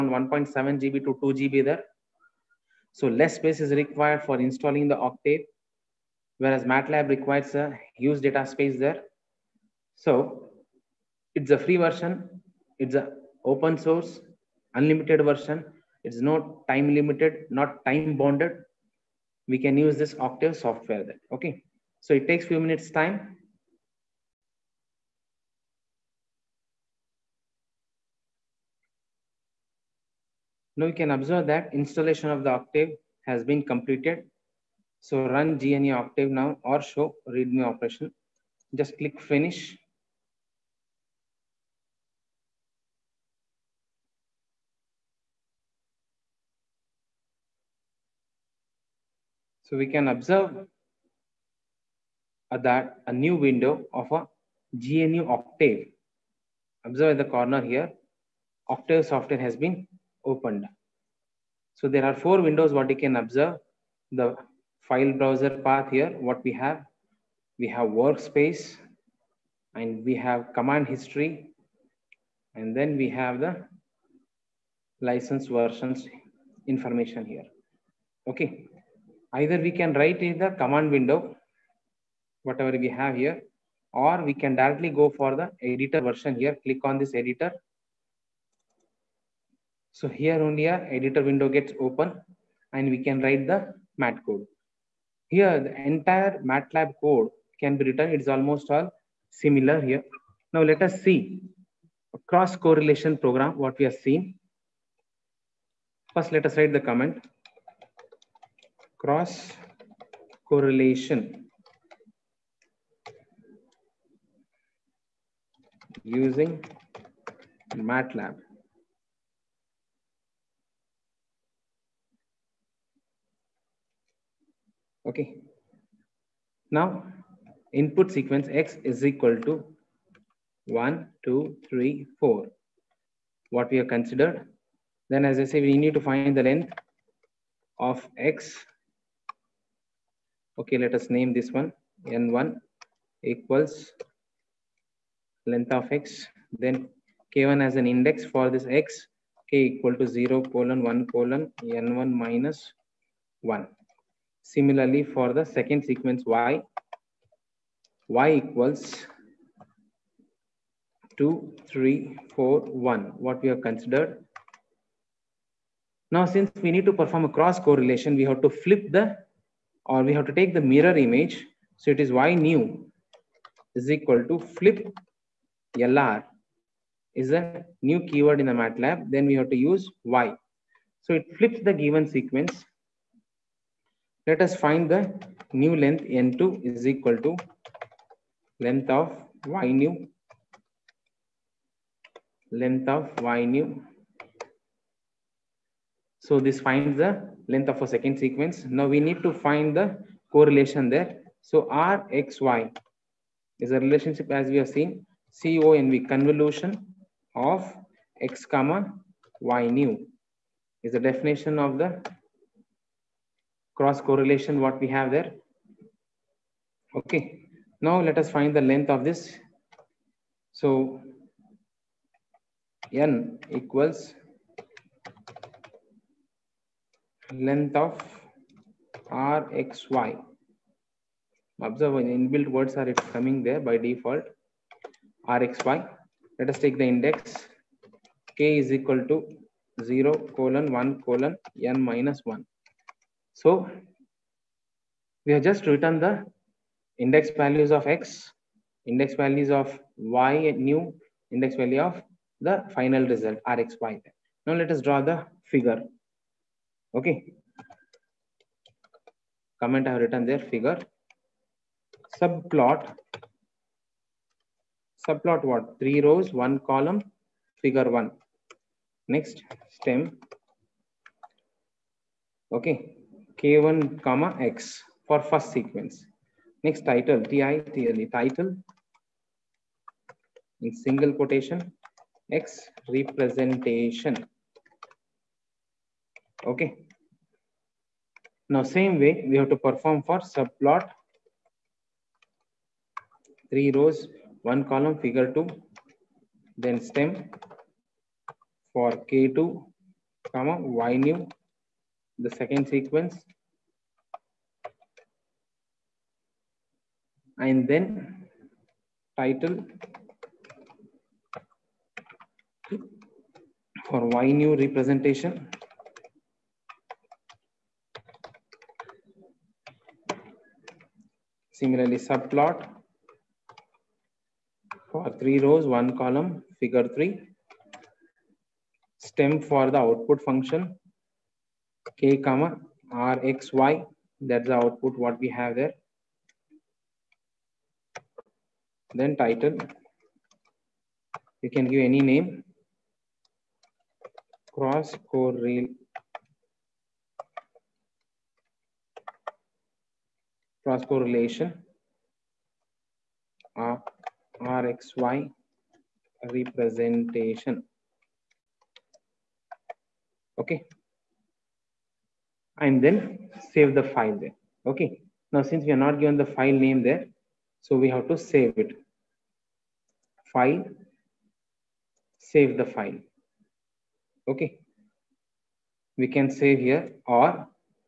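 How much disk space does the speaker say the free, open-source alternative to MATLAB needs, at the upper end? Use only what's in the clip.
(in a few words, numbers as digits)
2 GB.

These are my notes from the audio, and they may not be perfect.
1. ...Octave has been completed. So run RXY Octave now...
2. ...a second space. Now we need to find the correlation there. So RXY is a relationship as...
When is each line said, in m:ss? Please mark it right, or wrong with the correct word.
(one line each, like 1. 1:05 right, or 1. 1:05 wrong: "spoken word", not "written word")
1. 0:32 wrong: "GNU", not "RXY"
2. 3:17 wrong: "sequence", not "space".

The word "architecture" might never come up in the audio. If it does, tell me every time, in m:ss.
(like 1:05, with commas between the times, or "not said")
not said.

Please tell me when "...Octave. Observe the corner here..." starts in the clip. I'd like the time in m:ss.
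0:55.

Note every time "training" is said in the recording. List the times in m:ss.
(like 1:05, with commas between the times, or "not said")
not said.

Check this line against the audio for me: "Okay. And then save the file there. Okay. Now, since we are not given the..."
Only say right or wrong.
right.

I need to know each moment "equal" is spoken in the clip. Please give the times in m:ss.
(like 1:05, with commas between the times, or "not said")
2:09, 2:23, 2:29, 2:38, 2:53, 3:06, 3:43, 3:58.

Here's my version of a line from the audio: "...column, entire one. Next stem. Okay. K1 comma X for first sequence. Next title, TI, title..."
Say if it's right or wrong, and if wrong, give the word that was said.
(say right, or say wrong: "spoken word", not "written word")
wrong: "figure", not "entire".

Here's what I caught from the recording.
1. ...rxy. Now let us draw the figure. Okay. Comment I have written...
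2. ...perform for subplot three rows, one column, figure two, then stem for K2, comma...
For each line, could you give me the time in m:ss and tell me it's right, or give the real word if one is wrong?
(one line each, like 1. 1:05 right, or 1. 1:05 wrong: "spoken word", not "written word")
1. 4:13 right
2. 4:49 right.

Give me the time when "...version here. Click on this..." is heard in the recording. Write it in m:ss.
1:26.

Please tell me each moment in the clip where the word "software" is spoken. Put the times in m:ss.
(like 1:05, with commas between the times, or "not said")
0:20, 0:59.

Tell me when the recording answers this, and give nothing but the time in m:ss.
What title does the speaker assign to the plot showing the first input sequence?
4:42.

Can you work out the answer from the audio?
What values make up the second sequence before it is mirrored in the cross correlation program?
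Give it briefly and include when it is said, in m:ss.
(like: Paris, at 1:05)
2, 3, 4, 1, at 2:41.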